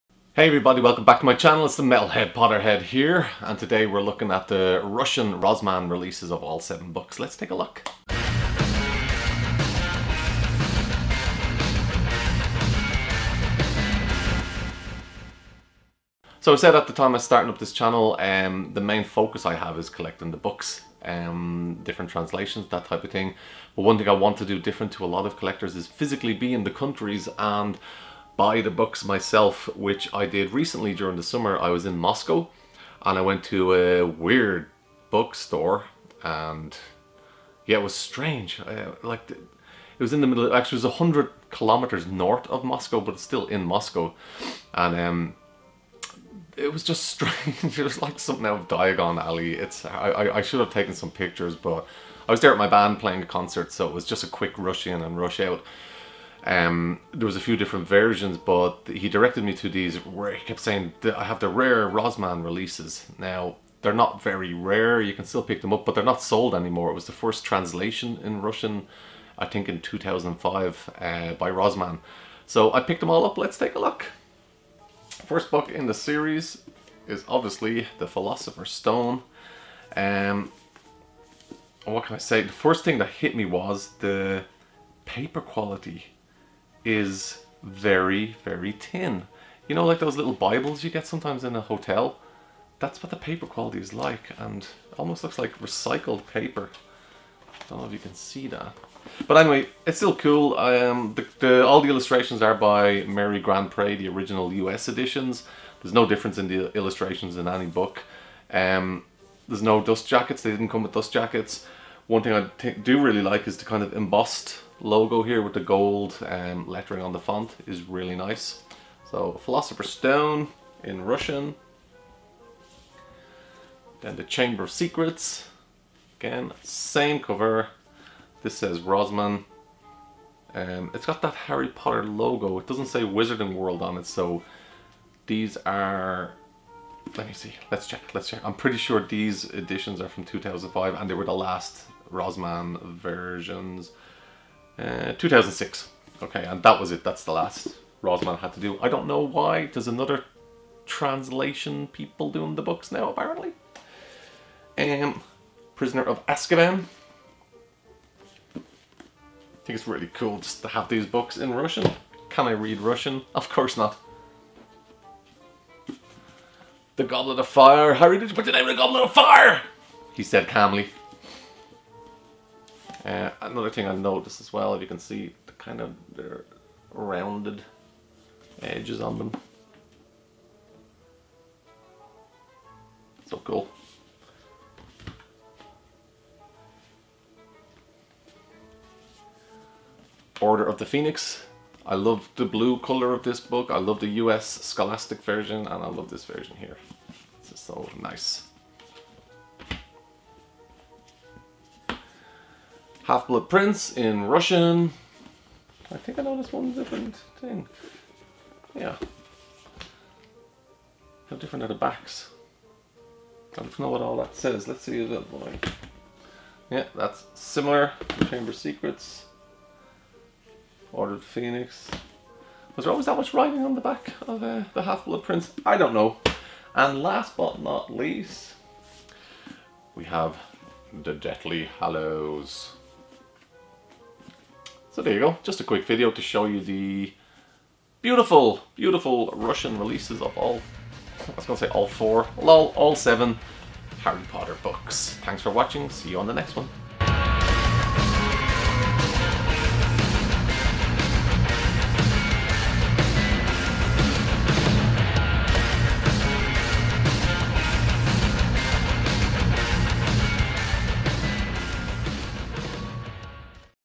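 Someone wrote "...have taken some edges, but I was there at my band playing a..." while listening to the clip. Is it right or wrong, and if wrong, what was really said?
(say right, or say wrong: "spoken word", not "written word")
wrong: "pictures", not "edges".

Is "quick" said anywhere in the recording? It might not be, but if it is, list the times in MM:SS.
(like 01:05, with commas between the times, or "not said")
00:54, 03:55.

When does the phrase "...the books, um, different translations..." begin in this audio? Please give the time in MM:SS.
00:20.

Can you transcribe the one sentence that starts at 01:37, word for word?
Don't know if you can see that.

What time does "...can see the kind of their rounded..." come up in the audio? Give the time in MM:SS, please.
02:54.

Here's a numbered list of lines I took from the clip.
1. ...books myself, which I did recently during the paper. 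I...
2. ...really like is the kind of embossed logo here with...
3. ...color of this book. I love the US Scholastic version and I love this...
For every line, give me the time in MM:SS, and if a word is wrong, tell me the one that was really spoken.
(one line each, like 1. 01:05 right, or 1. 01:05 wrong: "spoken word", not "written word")
1. 00:28 wrong: "summer", not "paper"
2. 01:53 right
3. 03:12 right.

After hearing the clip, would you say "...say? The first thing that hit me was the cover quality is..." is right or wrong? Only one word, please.
wrong.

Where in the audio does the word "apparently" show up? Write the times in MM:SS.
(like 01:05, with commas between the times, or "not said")
02:33.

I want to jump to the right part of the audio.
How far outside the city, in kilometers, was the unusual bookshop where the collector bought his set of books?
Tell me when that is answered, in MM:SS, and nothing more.
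00:40.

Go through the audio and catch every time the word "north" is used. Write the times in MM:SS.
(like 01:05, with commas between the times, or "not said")
00:42.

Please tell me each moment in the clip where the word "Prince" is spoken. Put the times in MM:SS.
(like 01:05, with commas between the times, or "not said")
03:23, 03:45.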